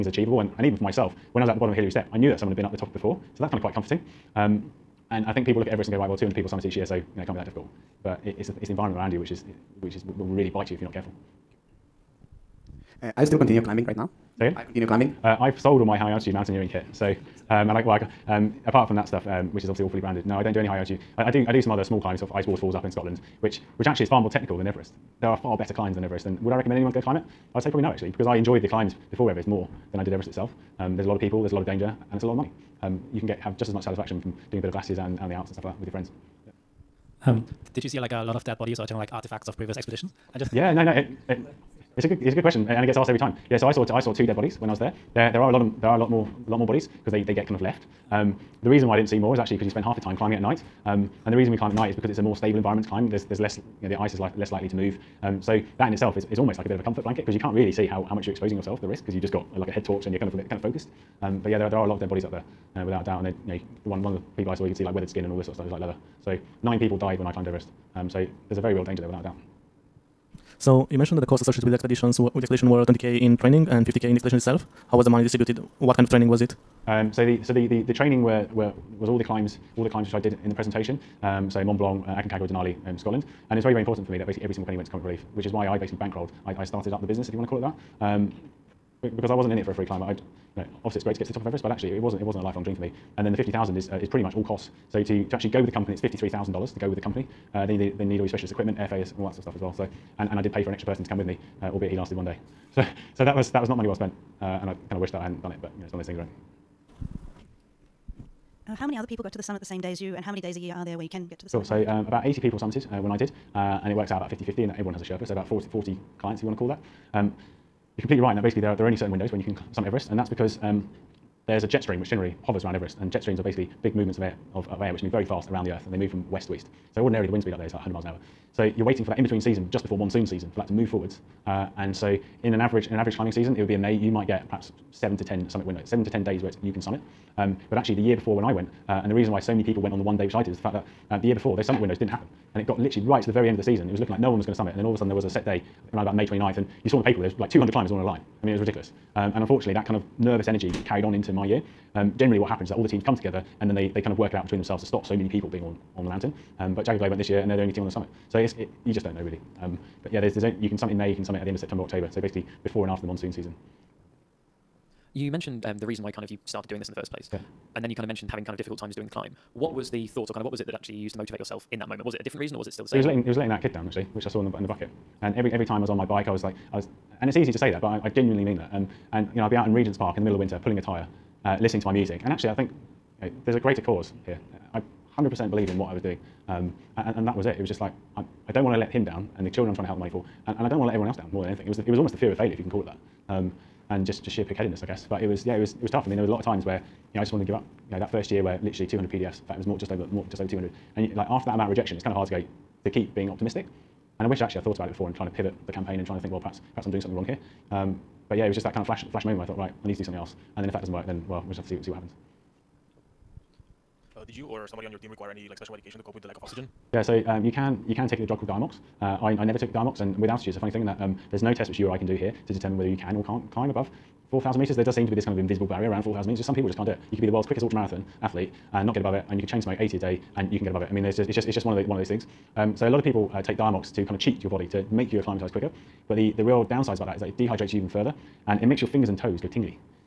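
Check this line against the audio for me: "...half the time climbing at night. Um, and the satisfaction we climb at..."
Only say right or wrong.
wrong.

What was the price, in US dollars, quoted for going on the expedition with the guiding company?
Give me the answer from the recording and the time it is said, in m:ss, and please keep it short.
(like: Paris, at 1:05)
$53,000, at 1:35.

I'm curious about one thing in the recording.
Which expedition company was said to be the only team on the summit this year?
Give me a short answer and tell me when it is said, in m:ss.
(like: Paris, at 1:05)
Jagged Globe, at 2:36.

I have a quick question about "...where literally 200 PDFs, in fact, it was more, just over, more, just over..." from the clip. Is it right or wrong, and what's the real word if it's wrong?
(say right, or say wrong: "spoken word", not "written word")
right.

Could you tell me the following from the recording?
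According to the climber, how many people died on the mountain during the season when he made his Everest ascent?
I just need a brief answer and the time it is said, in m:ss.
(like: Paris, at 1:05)
9, at 1:06.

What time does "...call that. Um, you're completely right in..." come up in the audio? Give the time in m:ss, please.
1:56.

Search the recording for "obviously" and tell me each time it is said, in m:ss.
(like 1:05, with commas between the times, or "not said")
0:19, 1:30.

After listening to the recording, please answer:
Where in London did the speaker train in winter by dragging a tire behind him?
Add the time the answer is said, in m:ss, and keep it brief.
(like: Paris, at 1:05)
Regent's Park, at 2:59.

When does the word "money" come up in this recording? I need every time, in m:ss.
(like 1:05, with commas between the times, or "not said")
0:32, 1:15, 1:43, 3:09.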